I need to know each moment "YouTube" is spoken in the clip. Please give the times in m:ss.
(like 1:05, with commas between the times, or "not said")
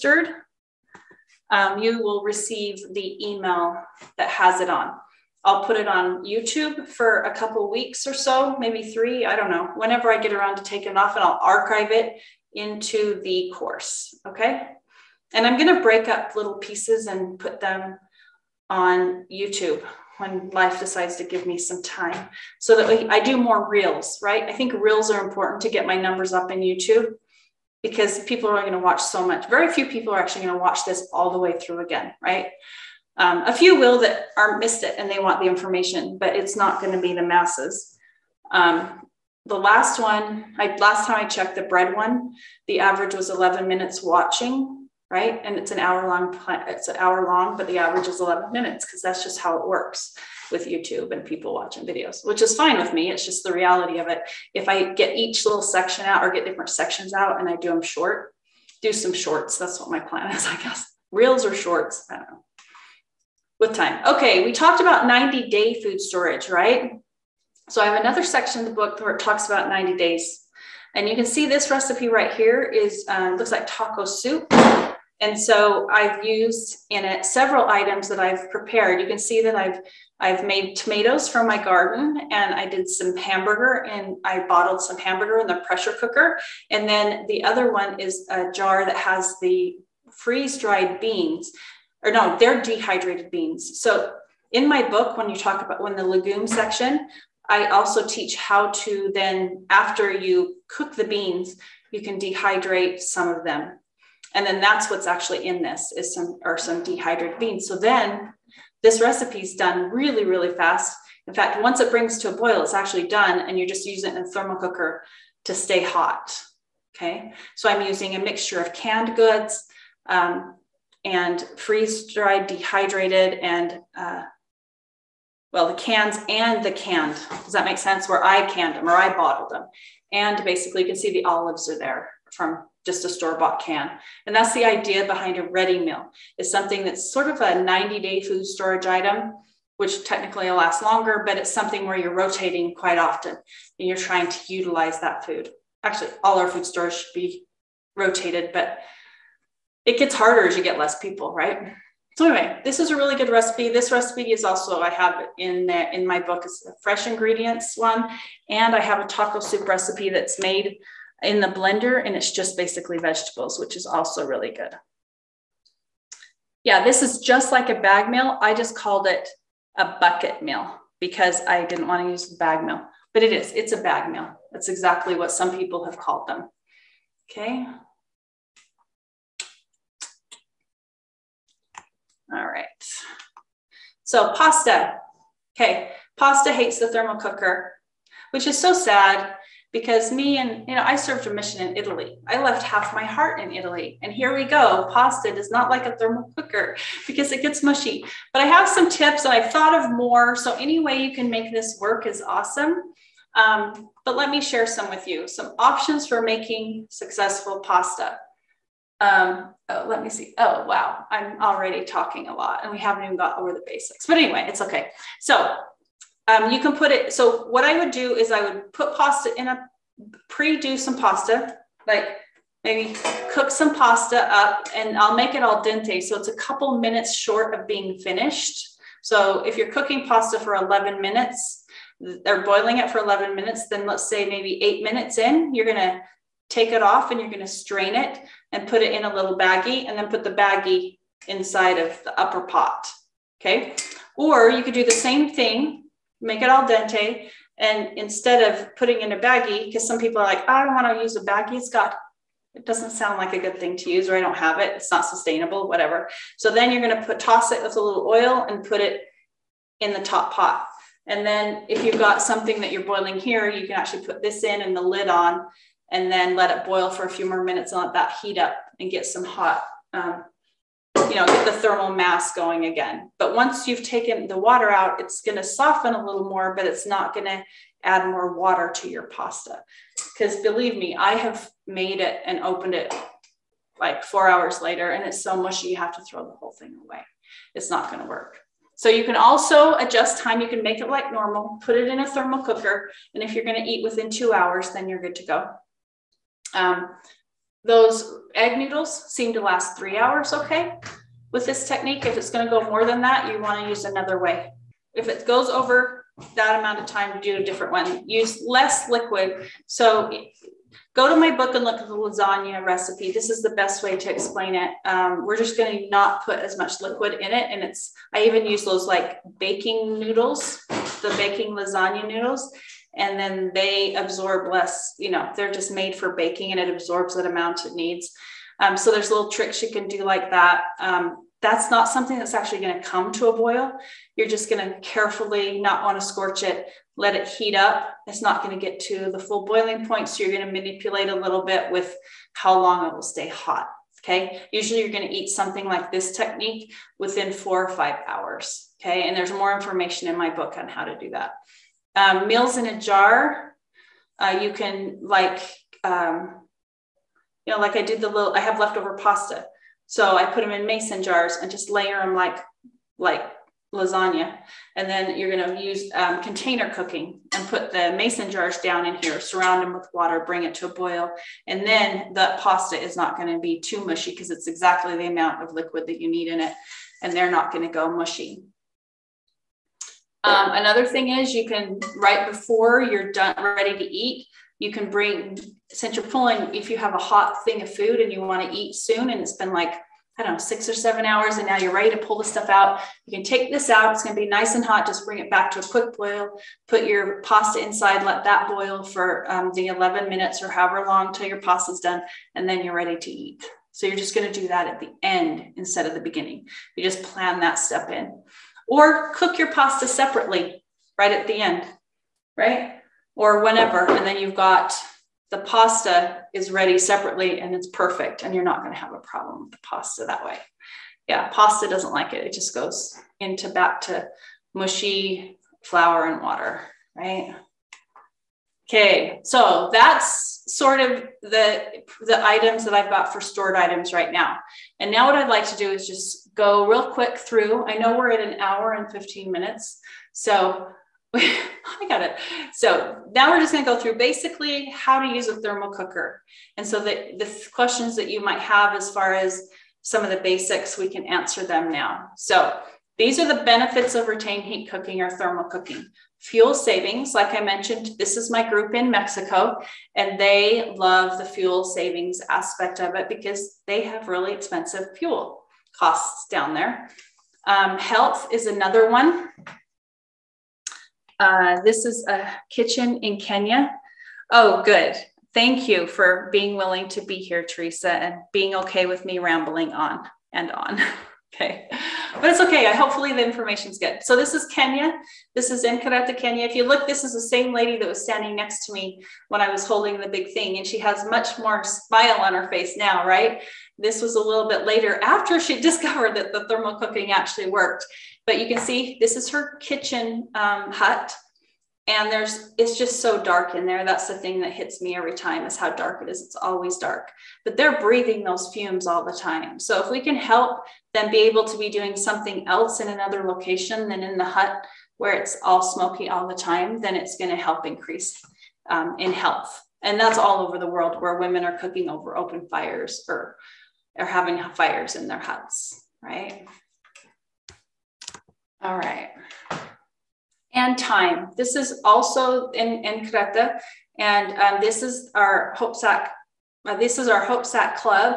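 0:06, 0:19, 0:26, 0:50.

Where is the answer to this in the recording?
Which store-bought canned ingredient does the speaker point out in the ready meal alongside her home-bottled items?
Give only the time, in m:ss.
2:11.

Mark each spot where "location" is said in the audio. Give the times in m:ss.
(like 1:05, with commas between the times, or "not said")
8:33.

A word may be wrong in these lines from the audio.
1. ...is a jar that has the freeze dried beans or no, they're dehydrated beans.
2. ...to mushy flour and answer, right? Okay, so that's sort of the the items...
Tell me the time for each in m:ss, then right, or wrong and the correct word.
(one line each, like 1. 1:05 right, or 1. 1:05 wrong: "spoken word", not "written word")
1. 1:27 right
2. 7:03 wrong: "water", not "answer".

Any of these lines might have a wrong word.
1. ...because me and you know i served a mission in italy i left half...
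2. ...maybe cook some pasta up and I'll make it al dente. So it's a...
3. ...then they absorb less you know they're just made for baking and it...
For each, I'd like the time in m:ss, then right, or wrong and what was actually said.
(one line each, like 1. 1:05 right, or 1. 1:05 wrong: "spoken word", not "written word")
1. 3:09 right
2. 3:42 right
3. 5:23 right.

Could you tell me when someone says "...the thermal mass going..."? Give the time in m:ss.
4:31.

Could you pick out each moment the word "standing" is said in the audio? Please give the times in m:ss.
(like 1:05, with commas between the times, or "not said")
8:08.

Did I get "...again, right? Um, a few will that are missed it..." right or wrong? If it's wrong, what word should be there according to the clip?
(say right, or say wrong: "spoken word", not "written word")
right.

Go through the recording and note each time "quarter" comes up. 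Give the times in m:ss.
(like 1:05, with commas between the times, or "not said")
not said.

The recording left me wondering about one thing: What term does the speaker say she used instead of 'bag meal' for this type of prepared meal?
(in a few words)
Bucket meal.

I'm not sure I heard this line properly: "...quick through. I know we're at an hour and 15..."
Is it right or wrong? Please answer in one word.
right.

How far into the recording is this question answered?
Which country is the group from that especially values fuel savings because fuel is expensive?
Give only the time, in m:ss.
7:38.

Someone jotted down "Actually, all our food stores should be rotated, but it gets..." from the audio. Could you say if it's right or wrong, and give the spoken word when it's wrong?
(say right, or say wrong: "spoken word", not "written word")
right.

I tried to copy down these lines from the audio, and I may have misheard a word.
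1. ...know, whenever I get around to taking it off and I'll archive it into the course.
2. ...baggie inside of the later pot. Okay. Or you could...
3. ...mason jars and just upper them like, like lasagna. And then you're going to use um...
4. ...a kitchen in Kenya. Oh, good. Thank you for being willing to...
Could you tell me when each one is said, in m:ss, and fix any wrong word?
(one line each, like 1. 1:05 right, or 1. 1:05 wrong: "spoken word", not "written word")
1. 0:09 right
2. 4:00 wrong: "upper", not "later"
3. 6:00 wrong: "layer", not "upper"
4. 7:52 right.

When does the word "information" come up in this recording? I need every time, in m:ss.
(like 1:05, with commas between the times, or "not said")
0:35, 5:49, 8:03.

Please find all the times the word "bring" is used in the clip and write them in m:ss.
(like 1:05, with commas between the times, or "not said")
1:51, 6:10, 6:24, 6:35.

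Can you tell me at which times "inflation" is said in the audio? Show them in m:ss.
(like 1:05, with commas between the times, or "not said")
not said.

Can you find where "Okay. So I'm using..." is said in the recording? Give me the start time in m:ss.
1:56.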